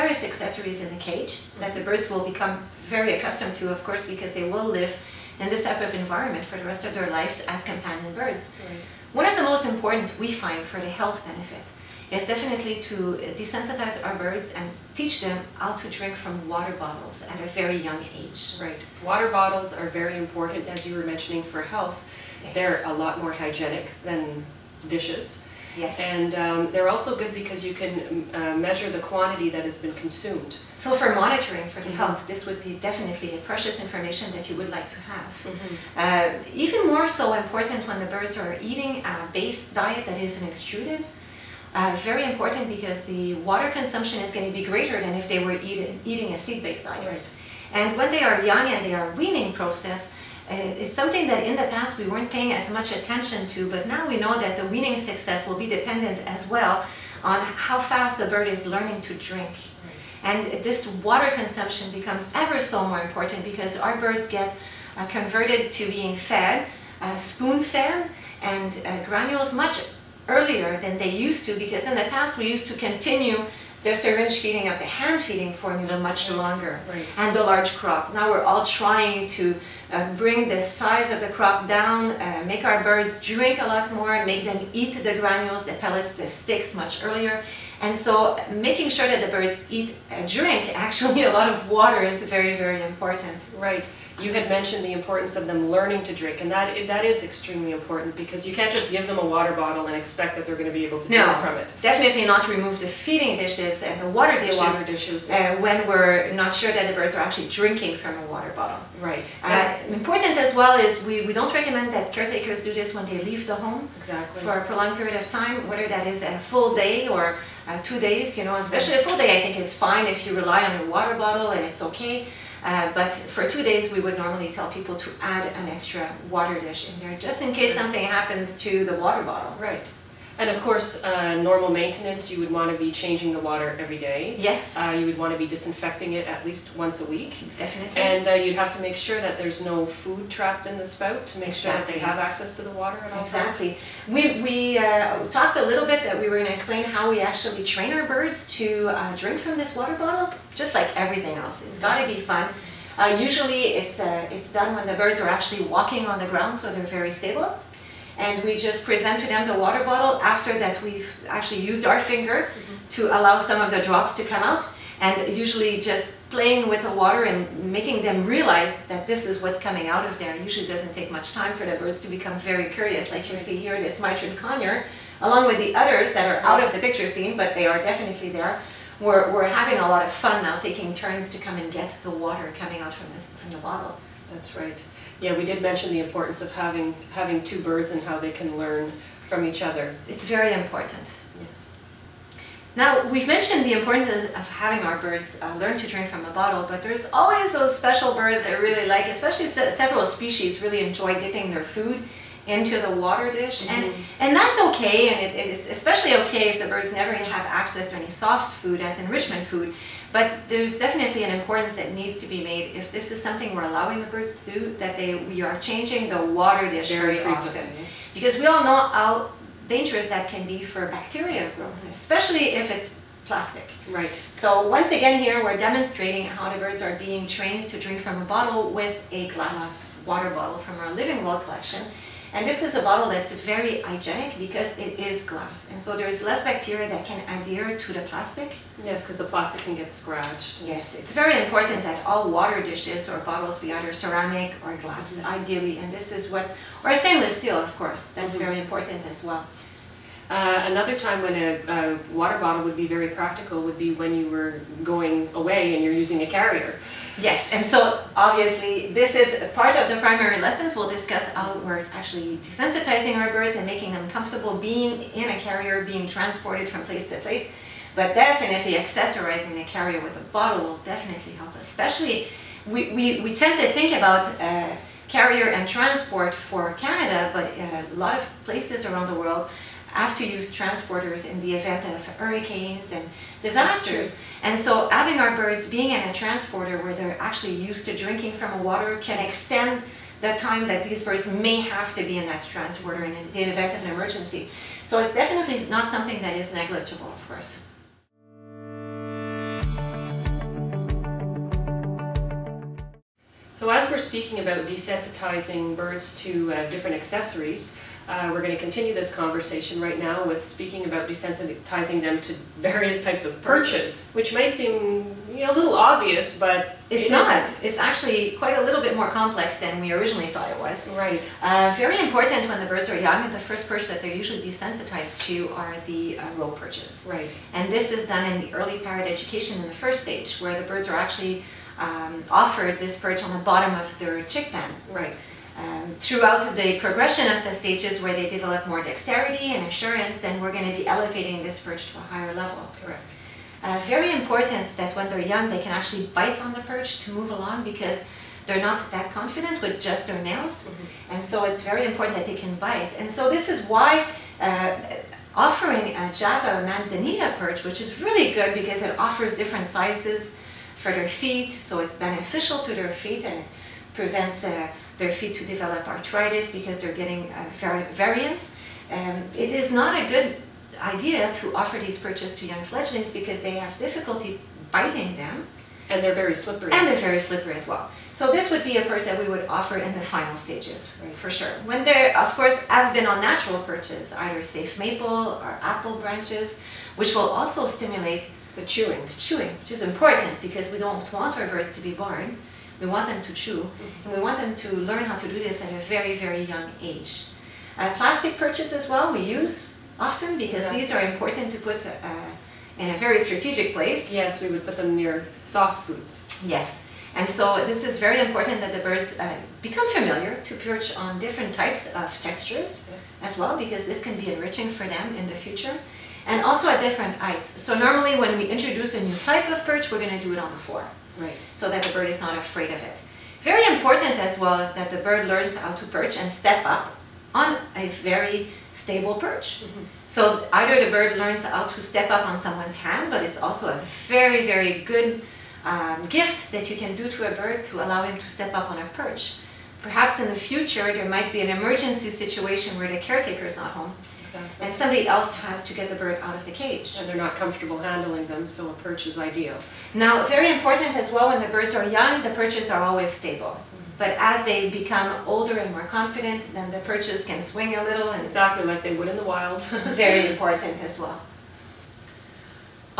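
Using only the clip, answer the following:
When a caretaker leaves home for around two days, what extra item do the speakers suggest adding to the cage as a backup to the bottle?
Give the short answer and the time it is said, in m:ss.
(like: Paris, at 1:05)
Extra water dish, at 2:05.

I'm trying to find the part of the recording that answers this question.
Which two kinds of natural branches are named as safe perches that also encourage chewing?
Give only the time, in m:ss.
6:24.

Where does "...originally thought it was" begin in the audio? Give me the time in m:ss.
5:19.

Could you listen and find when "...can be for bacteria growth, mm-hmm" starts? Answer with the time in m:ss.
3:40.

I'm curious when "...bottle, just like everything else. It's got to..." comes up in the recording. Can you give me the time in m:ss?
2:29.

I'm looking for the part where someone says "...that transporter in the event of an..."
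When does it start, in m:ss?
4:52.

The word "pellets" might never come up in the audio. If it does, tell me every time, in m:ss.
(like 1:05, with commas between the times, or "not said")
1:25.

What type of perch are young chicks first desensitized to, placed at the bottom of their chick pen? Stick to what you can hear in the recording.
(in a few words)
Rope perches.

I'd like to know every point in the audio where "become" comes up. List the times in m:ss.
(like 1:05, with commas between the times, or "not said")
0:02, 1:01, 2:52, 6:49, 7:34.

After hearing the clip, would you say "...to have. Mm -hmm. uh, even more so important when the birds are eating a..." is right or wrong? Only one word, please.
right.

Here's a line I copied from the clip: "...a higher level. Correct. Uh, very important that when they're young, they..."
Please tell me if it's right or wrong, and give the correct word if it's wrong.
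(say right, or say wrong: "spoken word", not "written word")
right.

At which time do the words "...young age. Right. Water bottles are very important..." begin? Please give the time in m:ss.
0:17.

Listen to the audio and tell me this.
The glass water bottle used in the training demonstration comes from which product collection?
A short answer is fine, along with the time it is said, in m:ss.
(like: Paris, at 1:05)
Living World, at 3:50.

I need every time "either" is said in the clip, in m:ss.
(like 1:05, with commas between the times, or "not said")
4:03, 6:24, 7:10.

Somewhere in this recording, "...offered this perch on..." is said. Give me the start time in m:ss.
5:32.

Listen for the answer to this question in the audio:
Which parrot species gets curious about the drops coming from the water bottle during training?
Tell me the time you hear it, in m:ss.
2:53.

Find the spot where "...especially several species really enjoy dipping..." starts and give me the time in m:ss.
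3:19.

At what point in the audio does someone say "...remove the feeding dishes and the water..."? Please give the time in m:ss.
1:42.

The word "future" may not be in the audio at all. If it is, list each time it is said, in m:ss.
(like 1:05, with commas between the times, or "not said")
6:55, 7:20.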